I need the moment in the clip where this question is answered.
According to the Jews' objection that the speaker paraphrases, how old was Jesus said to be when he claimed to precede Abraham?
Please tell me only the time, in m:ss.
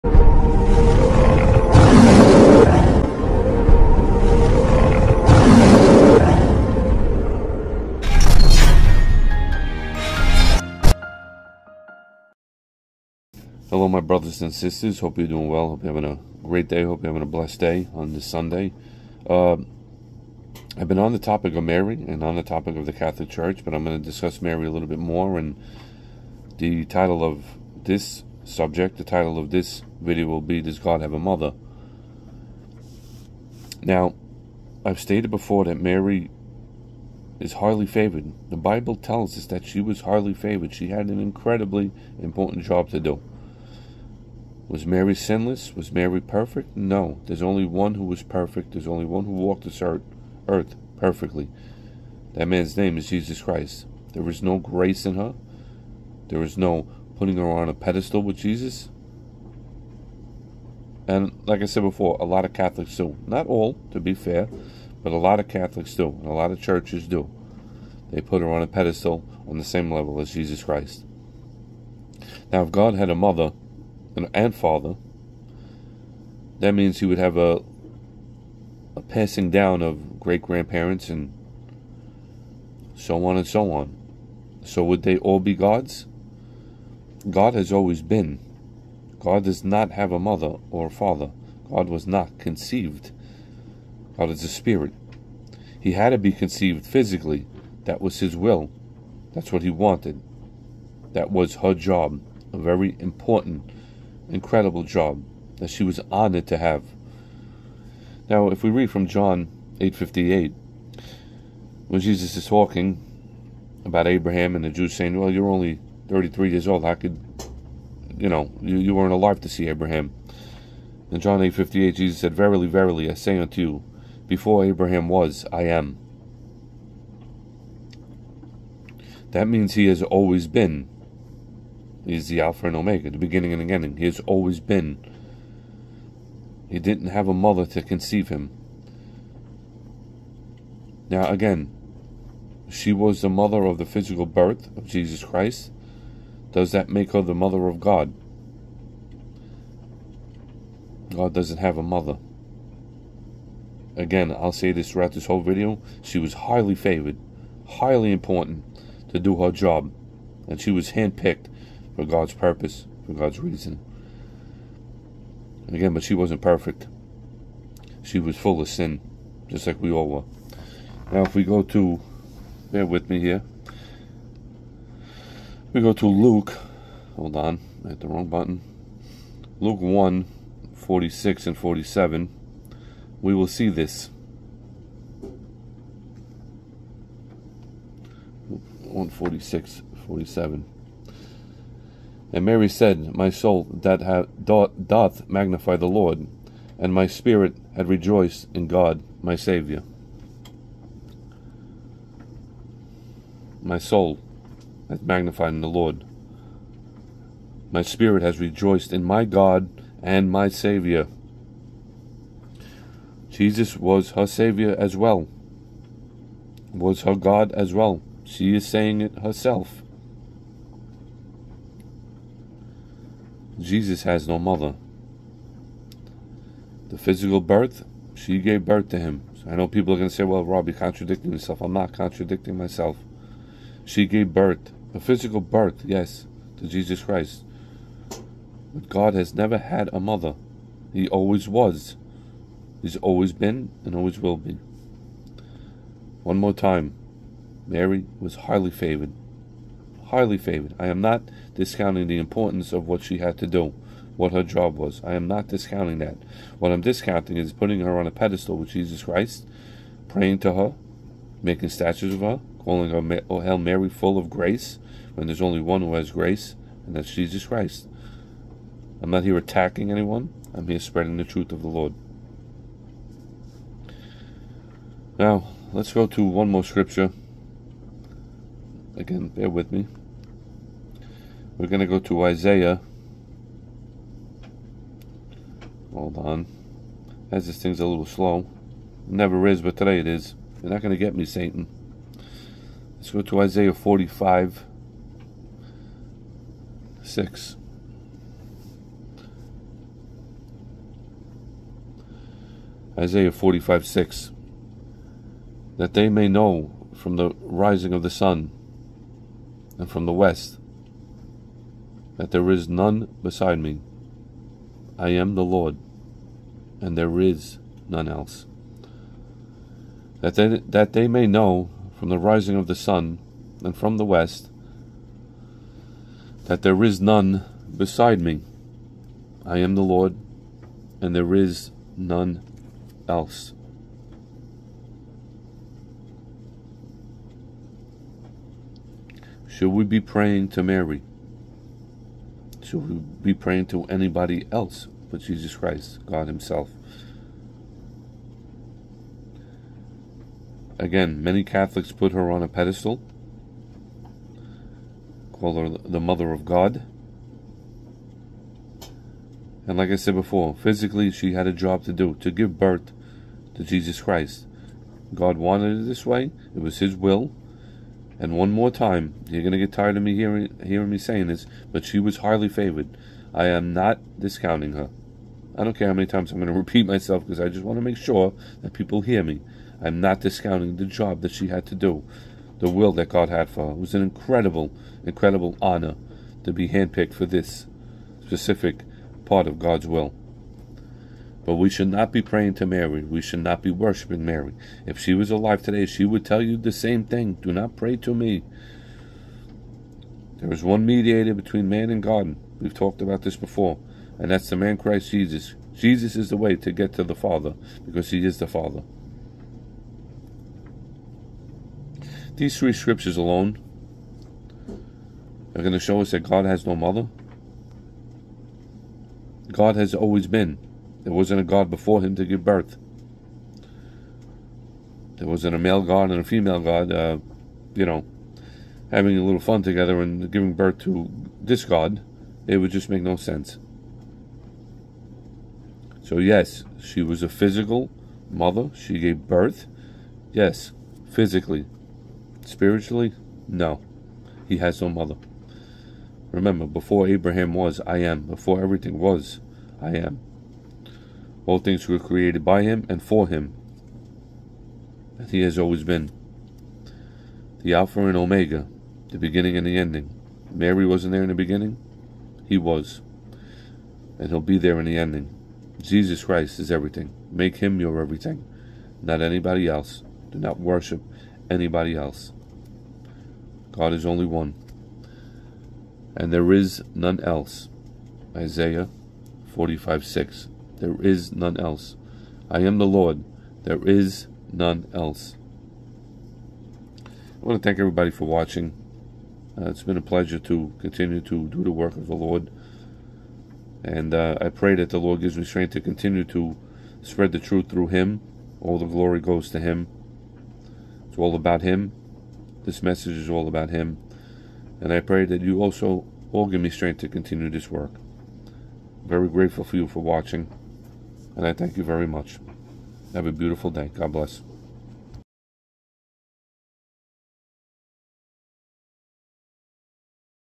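1:56.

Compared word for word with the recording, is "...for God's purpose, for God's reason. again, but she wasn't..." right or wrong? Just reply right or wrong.
right.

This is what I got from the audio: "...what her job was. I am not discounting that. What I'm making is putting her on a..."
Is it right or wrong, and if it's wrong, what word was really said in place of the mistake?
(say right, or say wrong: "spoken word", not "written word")
wrong: "discounting", not "making".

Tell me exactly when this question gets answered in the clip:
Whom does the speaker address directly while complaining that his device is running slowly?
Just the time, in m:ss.
4:51.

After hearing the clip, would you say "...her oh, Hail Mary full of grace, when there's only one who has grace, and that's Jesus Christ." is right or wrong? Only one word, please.
right.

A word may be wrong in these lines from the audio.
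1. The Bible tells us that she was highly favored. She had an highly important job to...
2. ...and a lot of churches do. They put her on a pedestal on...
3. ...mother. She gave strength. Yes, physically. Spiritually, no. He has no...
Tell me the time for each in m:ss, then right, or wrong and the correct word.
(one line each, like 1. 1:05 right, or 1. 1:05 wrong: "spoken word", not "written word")
1. 0:38 wrong: "incredibly", not "highly"
2. 1:06 right
3. 7:18 wrong: "birth", not "strength".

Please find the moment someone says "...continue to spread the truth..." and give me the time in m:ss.
8:15.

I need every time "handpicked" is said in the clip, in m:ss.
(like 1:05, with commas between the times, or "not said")
2:40, 6:26.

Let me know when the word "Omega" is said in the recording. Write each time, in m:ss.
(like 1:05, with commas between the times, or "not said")
2:12, 7:38.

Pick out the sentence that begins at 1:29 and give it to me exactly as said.
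God does not have a mother or a father.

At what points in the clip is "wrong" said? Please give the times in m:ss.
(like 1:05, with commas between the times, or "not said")
2:58.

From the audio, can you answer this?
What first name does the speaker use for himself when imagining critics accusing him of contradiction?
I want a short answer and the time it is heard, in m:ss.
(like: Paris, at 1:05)
Rob, at 3:50.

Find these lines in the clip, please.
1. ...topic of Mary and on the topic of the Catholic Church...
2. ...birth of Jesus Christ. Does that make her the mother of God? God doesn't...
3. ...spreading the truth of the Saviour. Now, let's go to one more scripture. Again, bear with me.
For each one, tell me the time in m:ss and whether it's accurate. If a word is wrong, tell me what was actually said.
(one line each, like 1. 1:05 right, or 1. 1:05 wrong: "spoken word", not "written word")
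1. 0:21 right
2. 2:24 right
3. 4:30 wrong: "Lord", not "Saviour".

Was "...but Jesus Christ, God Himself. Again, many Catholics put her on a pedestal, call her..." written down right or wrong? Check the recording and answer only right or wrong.
right.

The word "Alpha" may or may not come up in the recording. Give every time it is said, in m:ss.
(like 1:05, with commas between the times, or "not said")
2:12, 7:37.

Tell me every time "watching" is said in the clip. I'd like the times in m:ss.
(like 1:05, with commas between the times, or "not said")
8:08, 8:30.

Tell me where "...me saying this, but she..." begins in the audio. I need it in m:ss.
6:10.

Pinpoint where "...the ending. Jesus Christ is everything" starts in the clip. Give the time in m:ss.
7:44.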